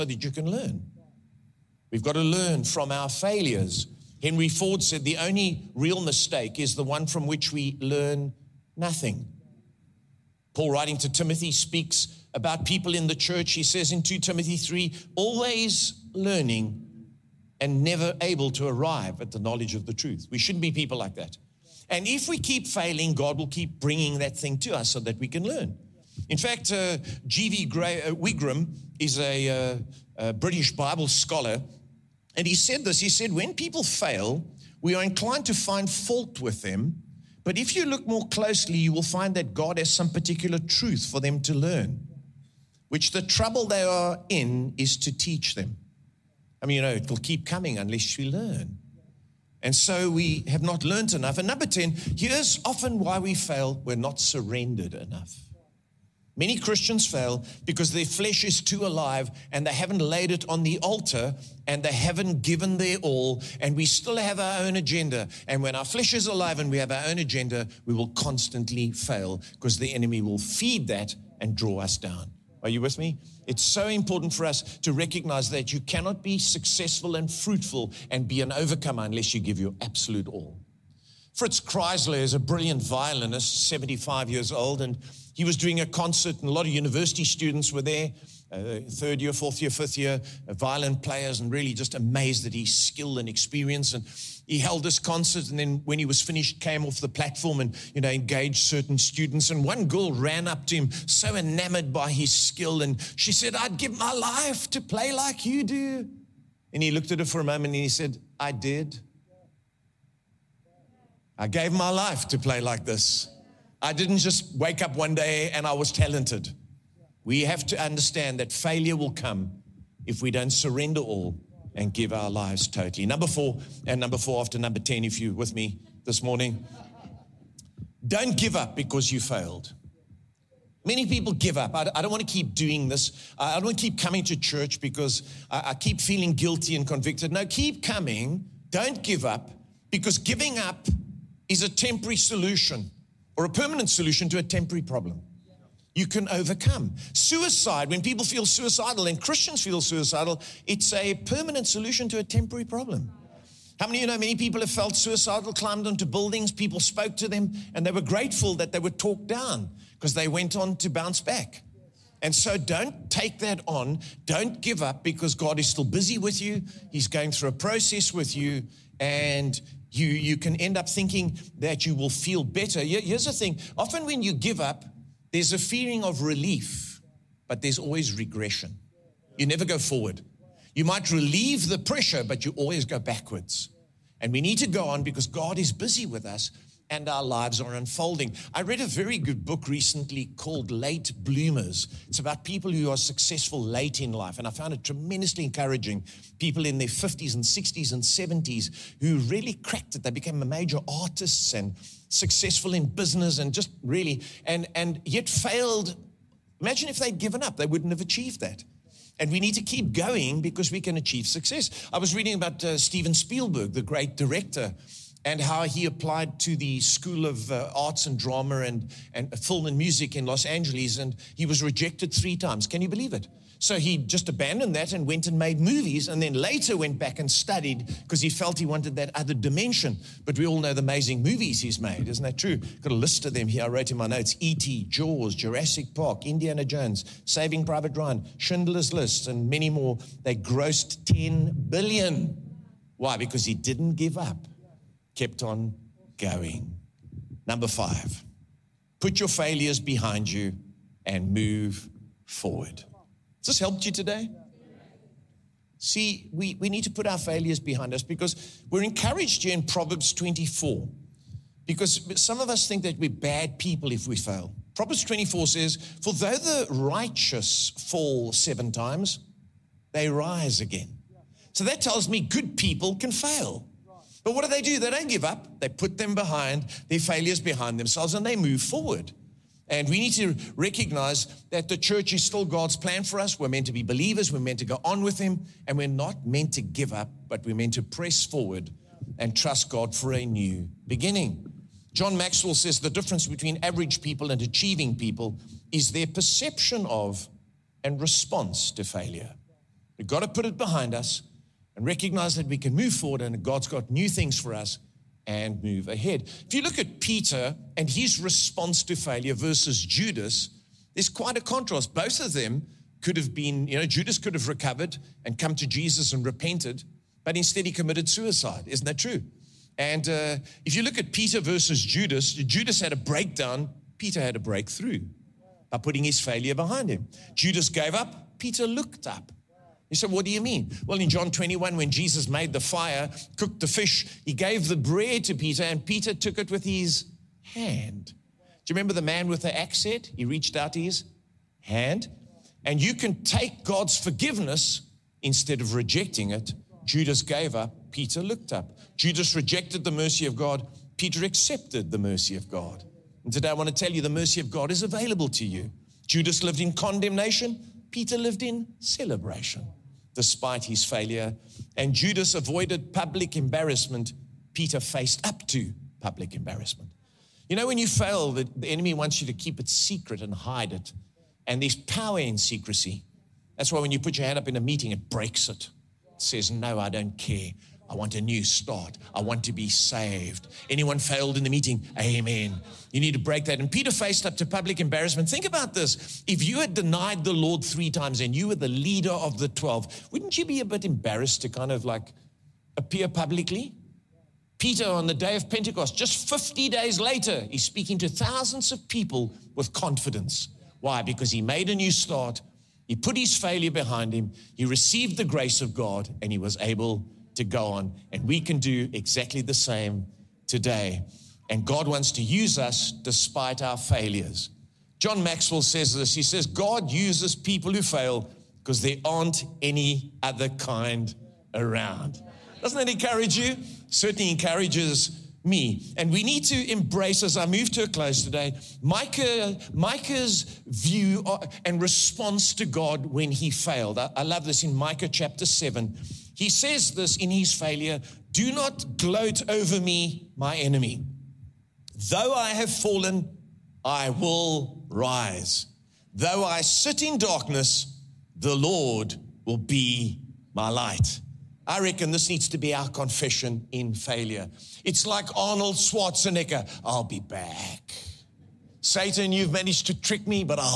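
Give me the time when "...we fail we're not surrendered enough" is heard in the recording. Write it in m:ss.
0:53.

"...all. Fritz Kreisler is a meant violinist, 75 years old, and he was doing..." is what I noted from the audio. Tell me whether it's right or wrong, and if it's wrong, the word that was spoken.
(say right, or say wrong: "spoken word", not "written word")
wrong: "brilliant", not "meant".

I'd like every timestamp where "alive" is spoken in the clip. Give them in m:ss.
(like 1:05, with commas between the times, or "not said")
0:58, 1:06.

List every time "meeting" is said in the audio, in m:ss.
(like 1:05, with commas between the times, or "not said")
6:14, 6:21.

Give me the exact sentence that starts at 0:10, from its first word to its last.
Paul, writing to Timothy, speaks about people in the church.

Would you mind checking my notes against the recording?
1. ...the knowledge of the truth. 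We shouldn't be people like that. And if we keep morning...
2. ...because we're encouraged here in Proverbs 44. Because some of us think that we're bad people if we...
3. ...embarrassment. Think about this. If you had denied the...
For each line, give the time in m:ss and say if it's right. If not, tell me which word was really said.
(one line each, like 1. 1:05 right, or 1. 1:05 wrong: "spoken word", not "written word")
1. 0:19 wrong: "failing", not "morning"
2. 4:18 wrong: "24", not "44"
3. 6:24 right.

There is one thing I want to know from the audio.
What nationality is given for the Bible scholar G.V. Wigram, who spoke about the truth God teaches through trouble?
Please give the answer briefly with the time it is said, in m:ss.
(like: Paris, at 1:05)
British, at 0:30.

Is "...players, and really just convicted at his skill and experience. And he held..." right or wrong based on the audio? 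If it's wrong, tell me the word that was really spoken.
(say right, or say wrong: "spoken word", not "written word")
wrong: "amazed", not "convicted".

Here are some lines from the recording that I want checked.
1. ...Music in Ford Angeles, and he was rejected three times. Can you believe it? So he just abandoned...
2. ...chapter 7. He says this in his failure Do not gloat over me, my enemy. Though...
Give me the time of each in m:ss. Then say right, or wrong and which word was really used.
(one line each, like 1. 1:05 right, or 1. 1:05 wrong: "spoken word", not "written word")
1. 3:39 wrong: "Los", not "Ford"
2. 7:15 right.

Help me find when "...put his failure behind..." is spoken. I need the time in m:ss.
6:42.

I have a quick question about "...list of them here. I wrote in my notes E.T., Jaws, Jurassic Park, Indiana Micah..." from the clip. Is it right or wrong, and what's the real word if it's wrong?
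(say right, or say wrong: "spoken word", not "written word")
wrong: "Jones", not "Micah".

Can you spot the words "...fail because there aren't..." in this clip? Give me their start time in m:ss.
6:57.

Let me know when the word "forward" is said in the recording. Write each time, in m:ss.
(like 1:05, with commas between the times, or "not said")
2:59, 4:12, 4:38, 4:48, 5:02.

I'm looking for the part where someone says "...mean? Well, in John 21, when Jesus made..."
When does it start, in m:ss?
5:30.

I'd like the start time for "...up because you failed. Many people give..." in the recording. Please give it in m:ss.
2:08.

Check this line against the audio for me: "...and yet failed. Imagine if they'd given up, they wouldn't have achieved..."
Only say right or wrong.
right.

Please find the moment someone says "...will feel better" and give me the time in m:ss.
2:51.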